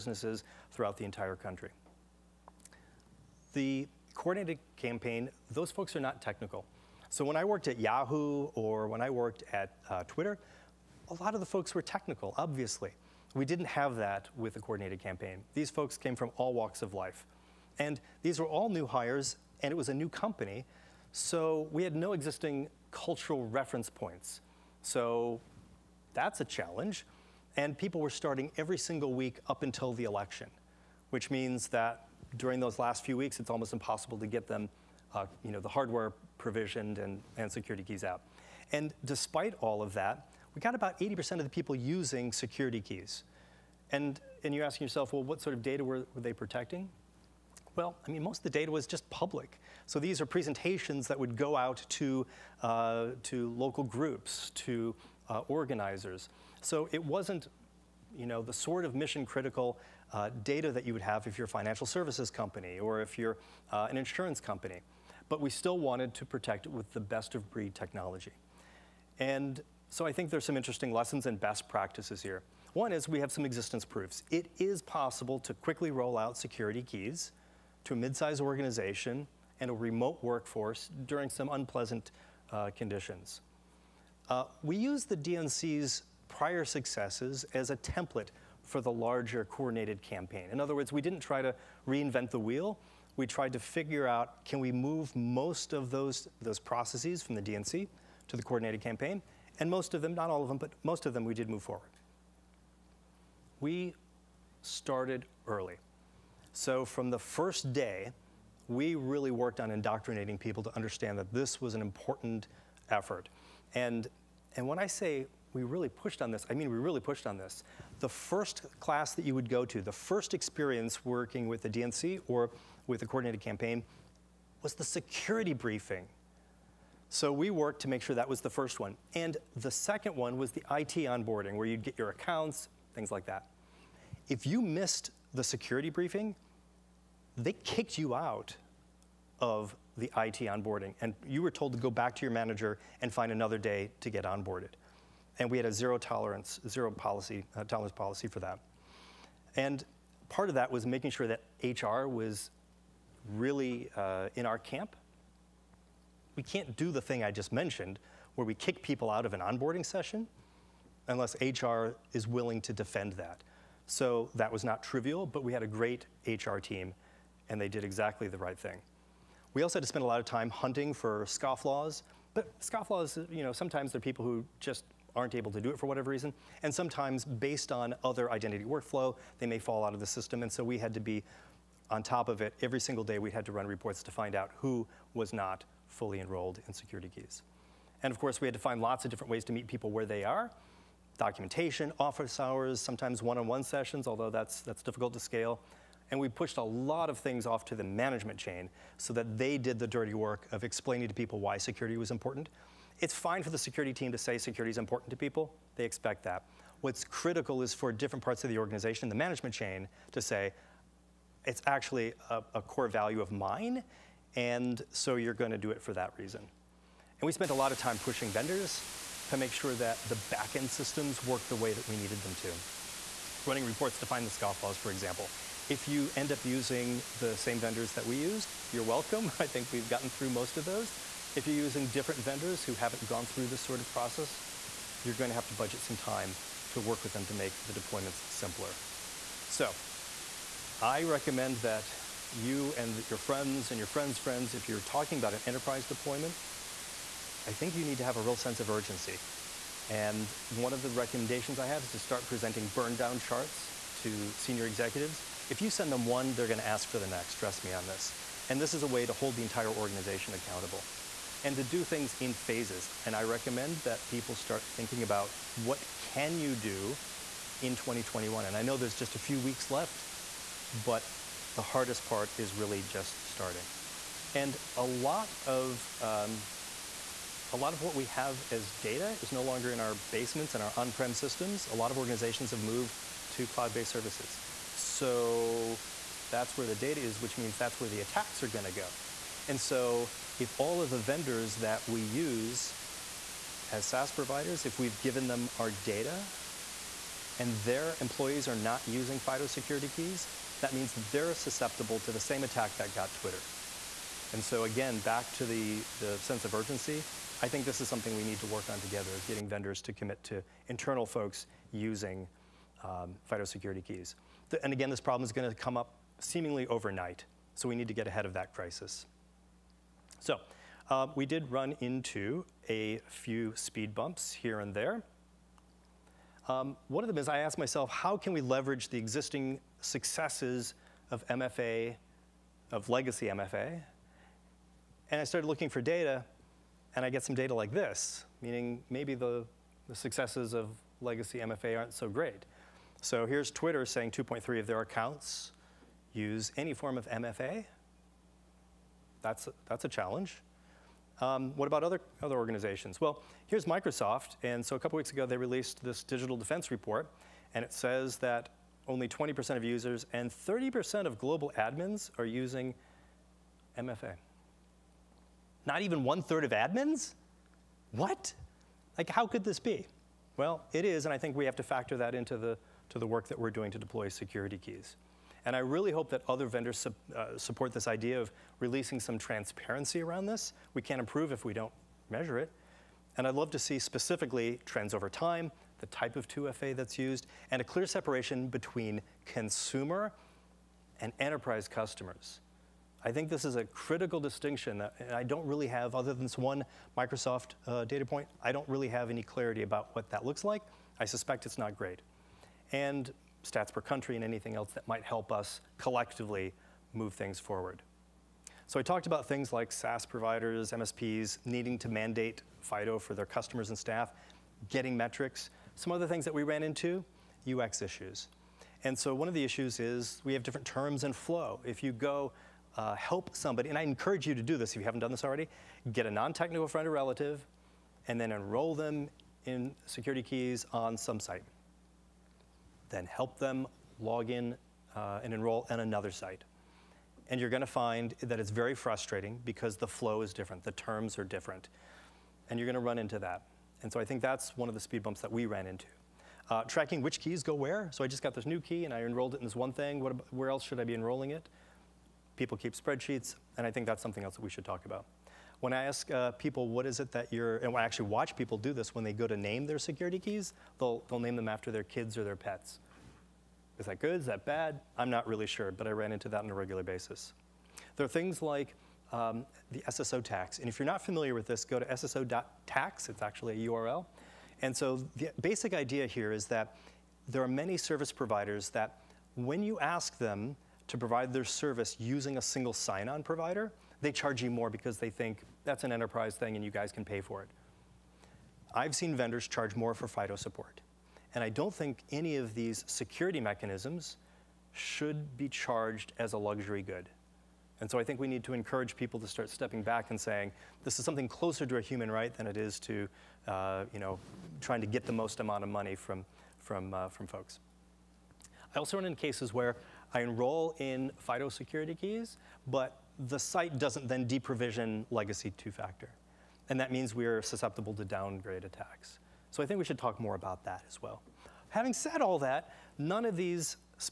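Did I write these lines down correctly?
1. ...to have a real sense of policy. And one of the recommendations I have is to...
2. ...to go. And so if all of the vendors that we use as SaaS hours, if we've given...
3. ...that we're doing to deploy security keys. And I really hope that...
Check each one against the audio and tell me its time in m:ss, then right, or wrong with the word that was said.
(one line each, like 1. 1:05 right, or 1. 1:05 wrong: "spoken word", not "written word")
1. 4:07 wrong: "urgency", not "policy"
2. 4:48 wrong: "providers", not "hours"
3. 6:13 right.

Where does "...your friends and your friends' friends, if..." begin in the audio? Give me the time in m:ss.
4:03.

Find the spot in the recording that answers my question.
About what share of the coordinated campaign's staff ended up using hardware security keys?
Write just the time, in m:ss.
0:40.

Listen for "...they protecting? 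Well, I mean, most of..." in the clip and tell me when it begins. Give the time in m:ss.
0:46.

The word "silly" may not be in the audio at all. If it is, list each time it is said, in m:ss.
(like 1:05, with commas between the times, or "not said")
not said.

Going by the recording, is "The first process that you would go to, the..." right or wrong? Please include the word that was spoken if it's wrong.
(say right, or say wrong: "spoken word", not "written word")
wrong: "class", not "process".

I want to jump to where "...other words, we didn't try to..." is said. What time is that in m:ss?
1:30.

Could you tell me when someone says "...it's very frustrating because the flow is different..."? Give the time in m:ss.
7:18.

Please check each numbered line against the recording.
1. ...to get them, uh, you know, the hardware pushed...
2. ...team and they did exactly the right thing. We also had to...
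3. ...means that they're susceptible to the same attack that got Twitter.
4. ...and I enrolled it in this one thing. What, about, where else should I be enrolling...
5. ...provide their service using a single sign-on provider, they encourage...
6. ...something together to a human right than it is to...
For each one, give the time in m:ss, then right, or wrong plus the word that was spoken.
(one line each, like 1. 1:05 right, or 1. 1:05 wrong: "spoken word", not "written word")
1. 0:34 wrong: "provisioned", not "pushed"
2. 2:46 right
3. 5:00 right
4. 7:28 right
5. 8:00 wrong: "charge", not "encourage"
6. 8:21 wrong: "closer", not "together".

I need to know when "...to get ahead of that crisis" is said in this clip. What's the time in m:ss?
5:17.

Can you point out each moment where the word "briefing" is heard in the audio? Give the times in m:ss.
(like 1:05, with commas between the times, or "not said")
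2:05, 2:15.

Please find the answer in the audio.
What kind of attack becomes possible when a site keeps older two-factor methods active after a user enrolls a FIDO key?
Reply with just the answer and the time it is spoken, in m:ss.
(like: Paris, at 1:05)
Downgrade attacks, at 8:38.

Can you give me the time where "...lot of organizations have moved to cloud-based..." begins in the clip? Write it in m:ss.
4:41.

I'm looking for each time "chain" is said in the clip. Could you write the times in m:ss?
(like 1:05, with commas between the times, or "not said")
3:18, 3:29.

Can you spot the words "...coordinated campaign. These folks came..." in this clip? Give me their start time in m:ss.
0:14.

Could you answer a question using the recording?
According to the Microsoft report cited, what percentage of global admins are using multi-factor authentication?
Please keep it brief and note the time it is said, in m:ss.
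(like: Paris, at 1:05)
30%, at 6:00.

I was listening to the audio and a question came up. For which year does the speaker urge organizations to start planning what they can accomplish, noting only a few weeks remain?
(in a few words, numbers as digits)
2021.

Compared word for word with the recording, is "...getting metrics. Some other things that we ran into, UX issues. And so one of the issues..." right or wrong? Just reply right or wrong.
right.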